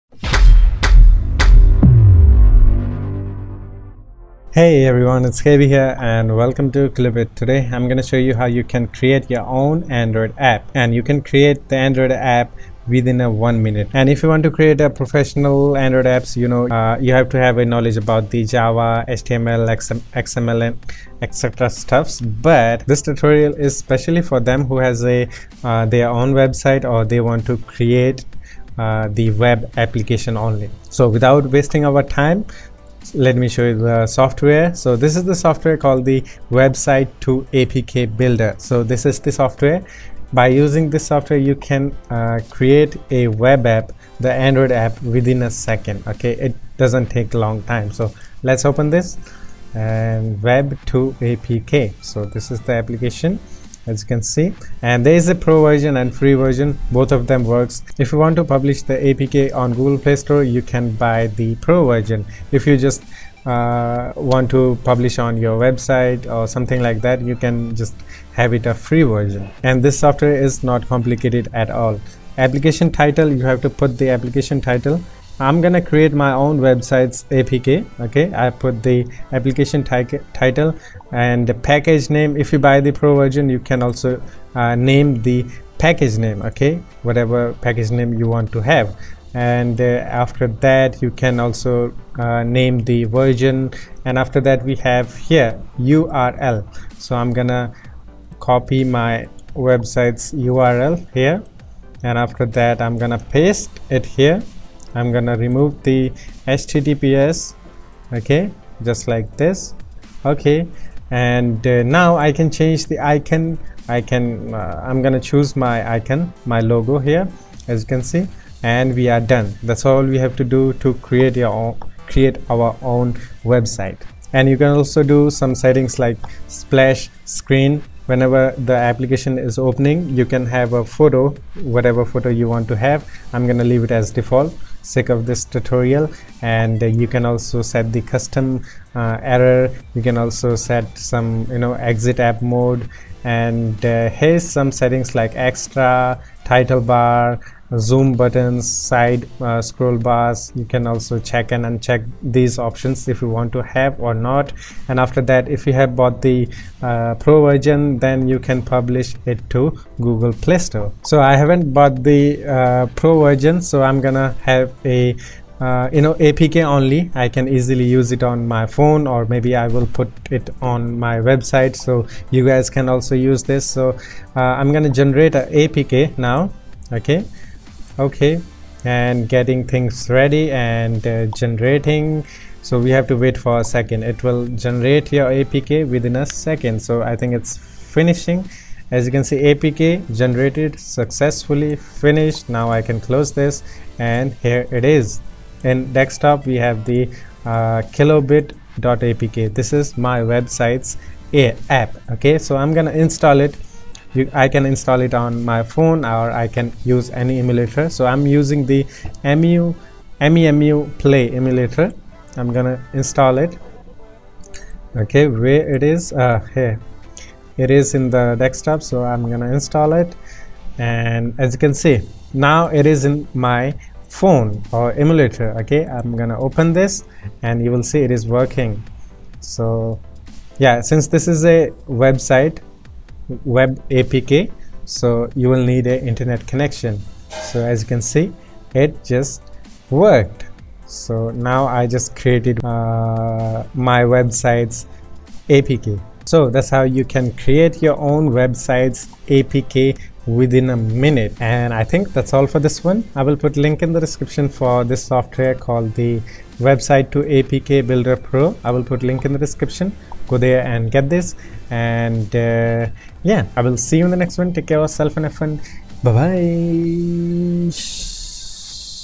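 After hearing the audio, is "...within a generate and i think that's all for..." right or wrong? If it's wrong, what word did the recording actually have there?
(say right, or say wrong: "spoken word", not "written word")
wrong: "minute", not "generate".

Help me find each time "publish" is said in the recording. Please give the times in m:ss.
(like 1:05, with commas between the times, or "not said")
0:58, 1:04, 2:38.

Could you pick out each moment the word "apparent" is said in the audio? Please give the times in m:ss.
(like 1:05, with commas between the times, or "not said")
not said.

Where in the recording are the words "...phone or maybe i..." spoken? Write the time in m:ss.
2:48.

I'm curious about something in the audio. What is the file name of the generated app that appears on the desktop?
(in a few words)
kilobit.apk.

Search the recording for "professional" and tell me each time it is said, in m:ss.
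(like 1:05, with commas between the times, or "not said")
0:14.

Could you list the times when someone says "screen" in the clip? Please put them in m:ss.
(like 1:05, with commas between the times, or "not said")
2:07.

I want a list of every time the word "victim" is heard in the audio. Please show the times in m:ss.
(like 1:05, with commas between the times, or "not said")
not said.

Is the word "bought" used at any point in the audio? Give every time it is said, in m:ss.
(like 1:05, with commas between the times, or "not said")
2:35, 2:41.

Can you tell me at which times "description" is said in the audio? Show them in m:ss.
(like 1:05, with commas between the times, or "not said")
4:13, 4:19.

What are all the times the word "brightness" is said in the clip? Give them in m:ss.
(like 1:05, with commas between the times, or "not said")
not said.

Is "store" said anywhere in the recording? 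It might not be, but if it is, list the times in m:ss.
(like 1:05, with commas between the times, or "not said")
1:00, 2:40.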